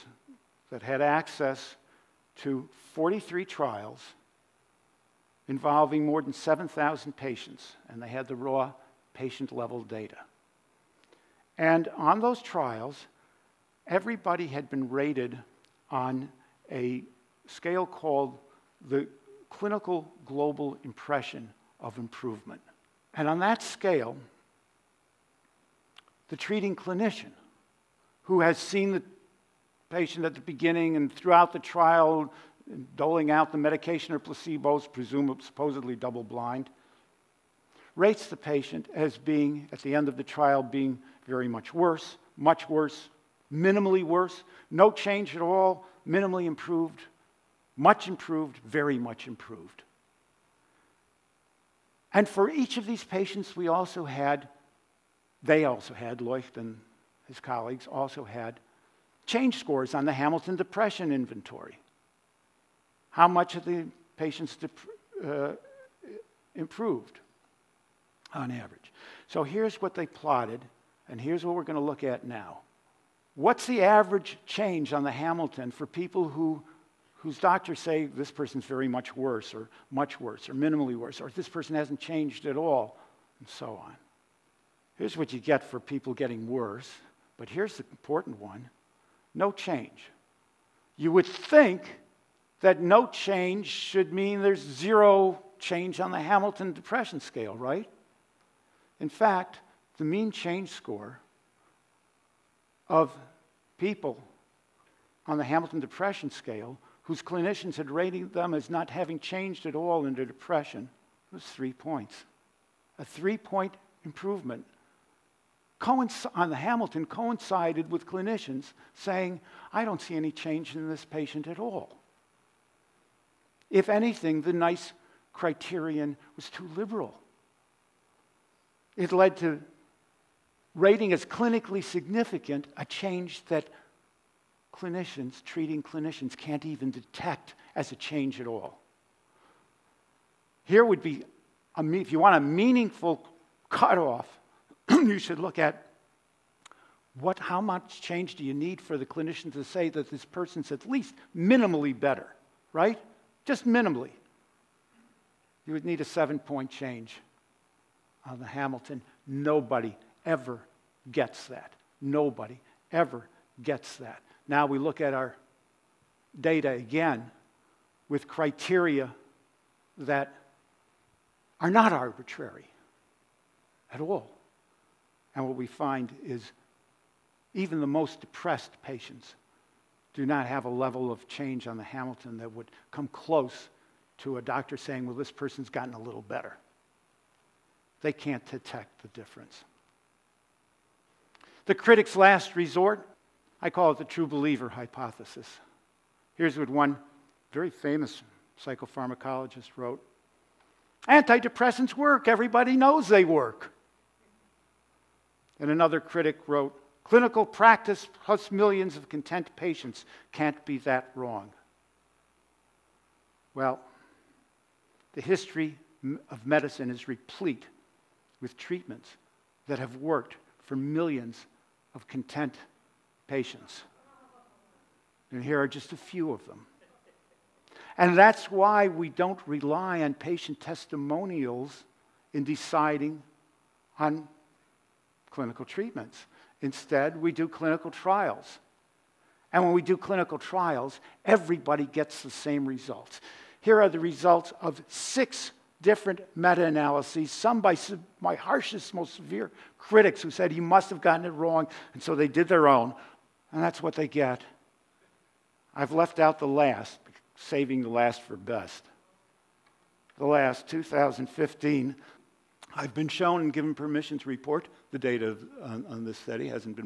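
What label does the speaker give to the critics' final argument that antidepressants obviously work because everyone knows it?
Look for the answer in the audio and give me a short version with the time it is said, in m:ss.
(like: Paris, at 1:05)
true believer hypothesis, at 3:14.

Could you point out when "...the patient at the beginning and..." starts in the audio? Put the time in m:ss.
0:28.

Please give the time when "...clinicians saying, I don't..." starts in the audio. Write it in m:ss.
1:58.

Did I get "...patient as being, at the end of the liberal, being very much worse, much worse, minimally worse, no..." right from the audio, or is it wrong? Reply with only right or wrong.
wrong.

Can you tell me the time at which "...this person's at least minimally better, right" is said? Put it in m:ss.
2:30.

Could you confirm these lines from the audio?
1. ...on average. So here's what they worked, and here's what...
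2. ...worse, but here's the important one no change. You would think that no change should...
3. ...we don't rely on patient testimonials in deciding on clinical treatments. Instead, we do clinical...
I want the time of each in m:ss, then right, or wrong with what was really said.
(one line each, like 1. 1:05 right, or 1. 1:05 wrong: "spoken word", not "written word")
1. 1:08 wrong: "plotted", not "worked"
2. 1:26 right
3. 3:48 right.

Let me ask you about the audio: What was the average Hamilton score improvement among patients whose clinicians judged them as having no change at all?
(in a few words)
3 points.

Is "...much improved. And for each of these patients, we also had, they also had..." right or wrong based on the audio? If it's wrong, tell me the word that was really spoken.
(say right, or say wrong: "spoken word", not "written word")
right.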